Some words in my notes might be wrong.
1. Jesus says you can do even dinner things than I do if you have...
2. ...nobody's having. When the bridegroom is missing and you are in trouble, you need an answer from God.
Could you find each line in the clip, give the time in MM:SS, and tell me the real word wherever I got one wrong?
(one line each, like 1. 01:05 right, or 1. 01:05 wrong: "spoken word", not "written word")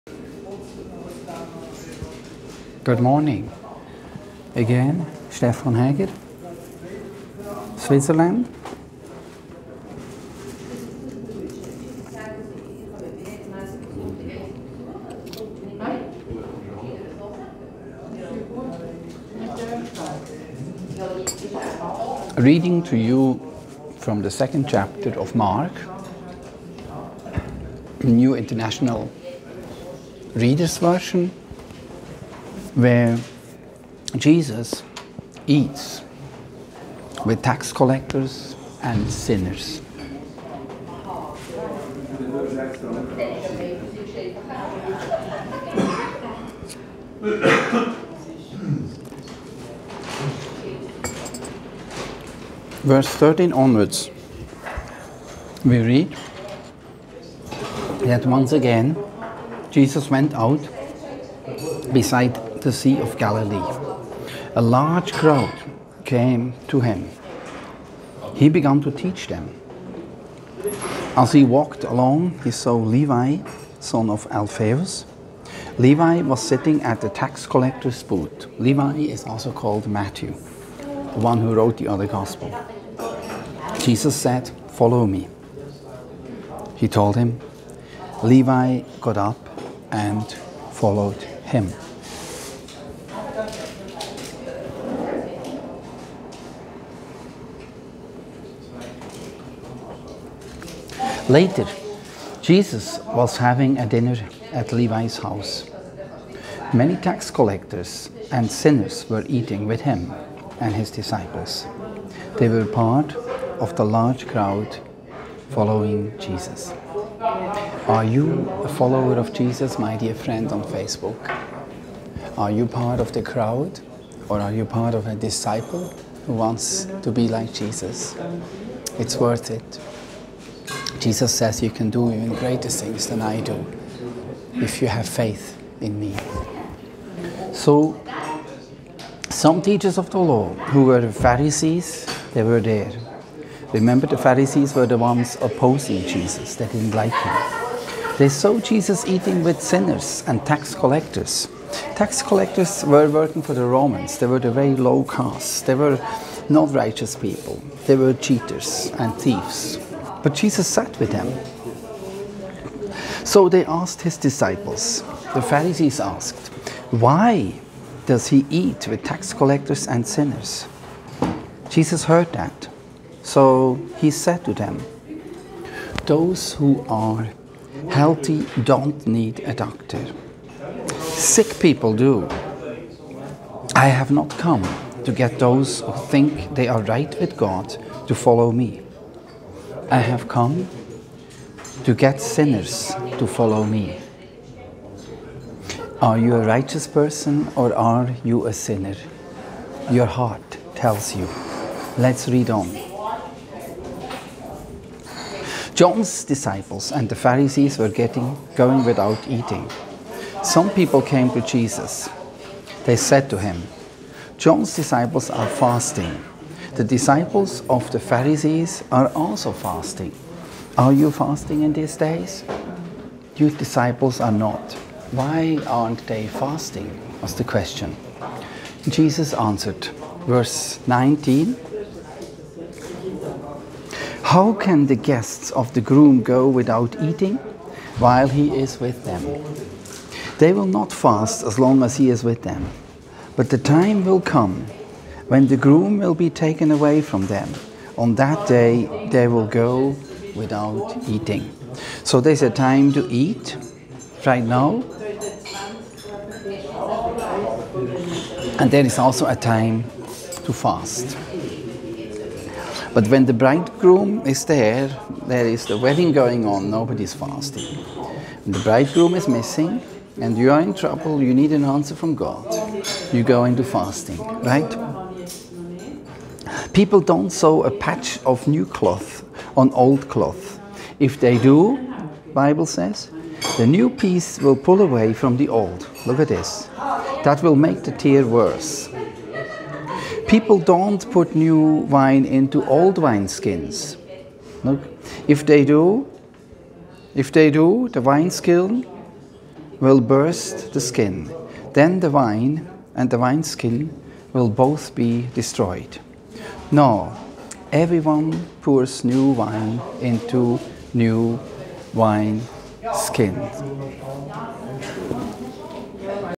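1. 02:11 wrong: "greater", not "dinner"
2. 04:26 wrong: "fasting", not "having".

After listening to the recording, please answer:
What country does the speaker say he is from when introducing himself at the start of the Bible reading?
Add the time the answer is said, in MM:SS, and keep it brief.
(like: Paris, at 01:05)
Switzerland, at 00:07.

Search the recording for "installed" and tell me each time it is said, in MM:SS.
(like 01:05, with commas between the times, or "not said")
not said.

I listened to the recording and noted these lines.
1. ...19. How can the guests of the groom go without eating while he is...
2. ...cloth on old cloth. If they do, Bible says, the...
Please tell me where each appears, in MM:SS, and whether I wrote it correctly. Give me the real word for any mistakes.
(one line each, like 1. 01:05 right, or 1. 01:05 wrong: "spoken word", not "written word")
1. 03:50 right
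2. 04:38 right.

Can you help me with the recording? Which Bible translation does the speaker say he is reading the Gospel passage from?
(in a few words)
New International Reader's Version.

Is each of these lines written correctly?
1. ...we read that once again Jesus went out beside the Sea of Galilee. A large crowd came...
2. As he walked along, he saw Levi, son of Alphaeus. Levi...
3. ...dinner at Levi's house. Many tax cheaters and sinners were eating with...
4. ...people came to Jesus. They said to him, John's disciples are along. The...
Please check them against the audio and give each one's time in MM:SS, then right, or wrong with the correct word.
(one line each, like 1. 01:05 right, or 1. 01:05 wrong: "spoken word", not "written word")
1. 00:55 right
2. 01:11 right
3. 01:43 wrong: "collectors", not "cheaters"
4. 03:30 wrong: "fasting", not "along".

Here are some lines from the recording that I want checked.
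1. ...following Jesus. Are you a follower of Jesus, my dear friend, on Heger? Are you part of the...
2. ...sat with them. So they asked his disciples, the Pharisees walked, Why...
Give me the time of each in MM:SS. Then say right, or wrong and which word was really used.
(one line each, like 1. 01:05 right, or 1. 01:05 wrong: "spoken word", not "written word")
1. 01:55 wrong: "Facebook", not "Heger"
2. 02:40 wrong: "asked", not "walked".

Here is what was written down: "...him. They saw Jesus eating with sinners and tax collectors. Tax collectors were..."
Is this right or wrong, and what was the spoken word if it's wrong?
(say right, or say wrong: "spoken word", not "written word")
right.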